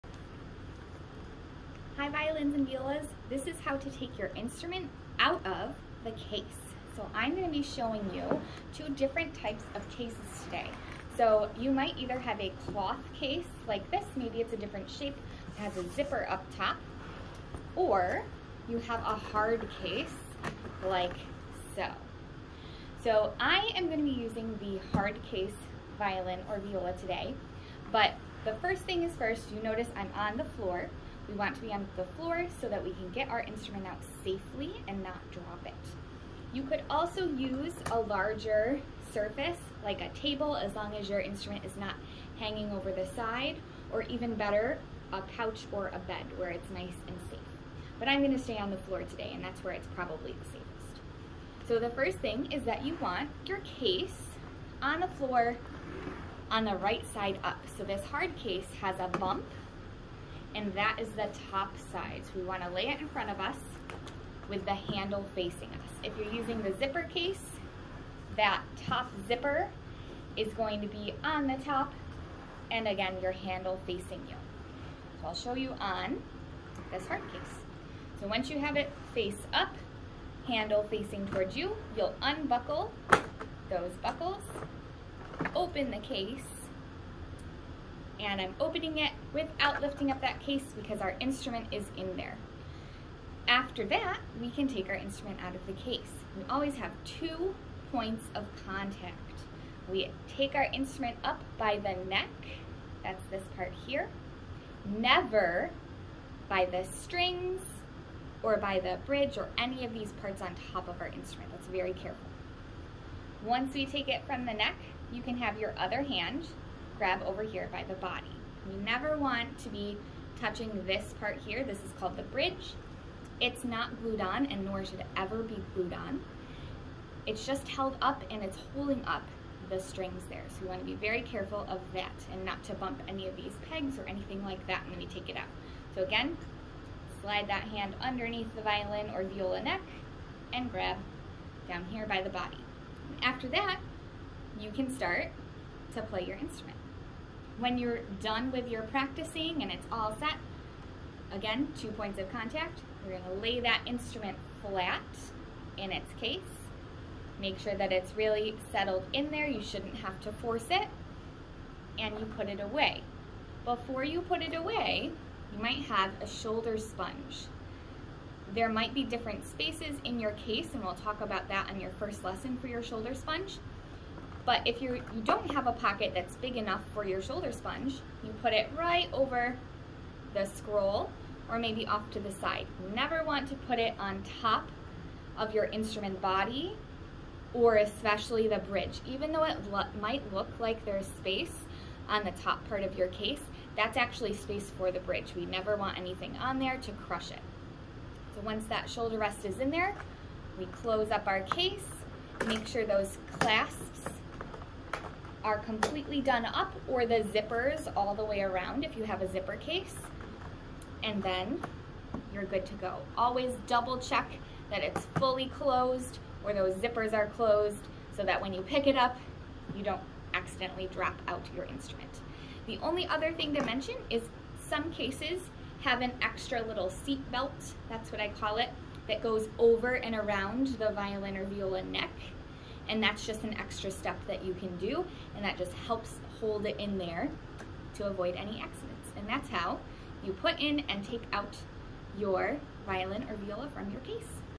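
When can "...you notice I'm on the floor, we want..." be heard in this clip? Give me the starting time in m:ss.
0:29.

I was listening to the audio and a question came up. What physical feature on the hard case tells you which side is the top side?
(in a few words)
A bump.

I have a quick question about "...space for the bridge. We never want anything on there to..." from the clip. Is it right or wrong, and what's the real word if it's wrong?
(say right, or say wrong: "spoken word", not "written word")
right.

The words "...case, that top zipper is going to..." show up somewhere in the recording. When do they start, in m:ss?
1:07.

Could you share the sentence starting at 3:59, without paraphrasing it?
And that's how you put in and take out your violin or viola from your case.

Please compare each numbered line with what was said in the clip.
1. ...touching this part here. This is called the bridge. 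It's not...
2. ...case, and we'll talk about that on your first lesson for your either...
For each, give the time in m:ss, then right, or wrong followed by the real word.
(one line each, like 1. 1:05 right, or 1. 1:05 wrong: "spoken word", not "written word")
1. 2:00 right
2. 2:50 wrong: "shoulder", not "either".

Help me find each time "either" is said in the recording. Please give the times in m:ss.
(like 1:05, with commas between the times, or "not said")
0:11.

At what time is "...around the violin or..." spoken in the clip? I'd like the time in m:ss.
3:50.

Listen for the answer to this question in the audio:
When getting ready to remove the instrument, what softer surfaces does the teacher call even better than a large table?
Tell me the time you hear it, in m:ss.
0:45.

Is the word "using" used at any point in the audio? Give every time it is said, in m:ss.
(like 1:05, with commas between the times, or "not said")
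0:24, 1:06.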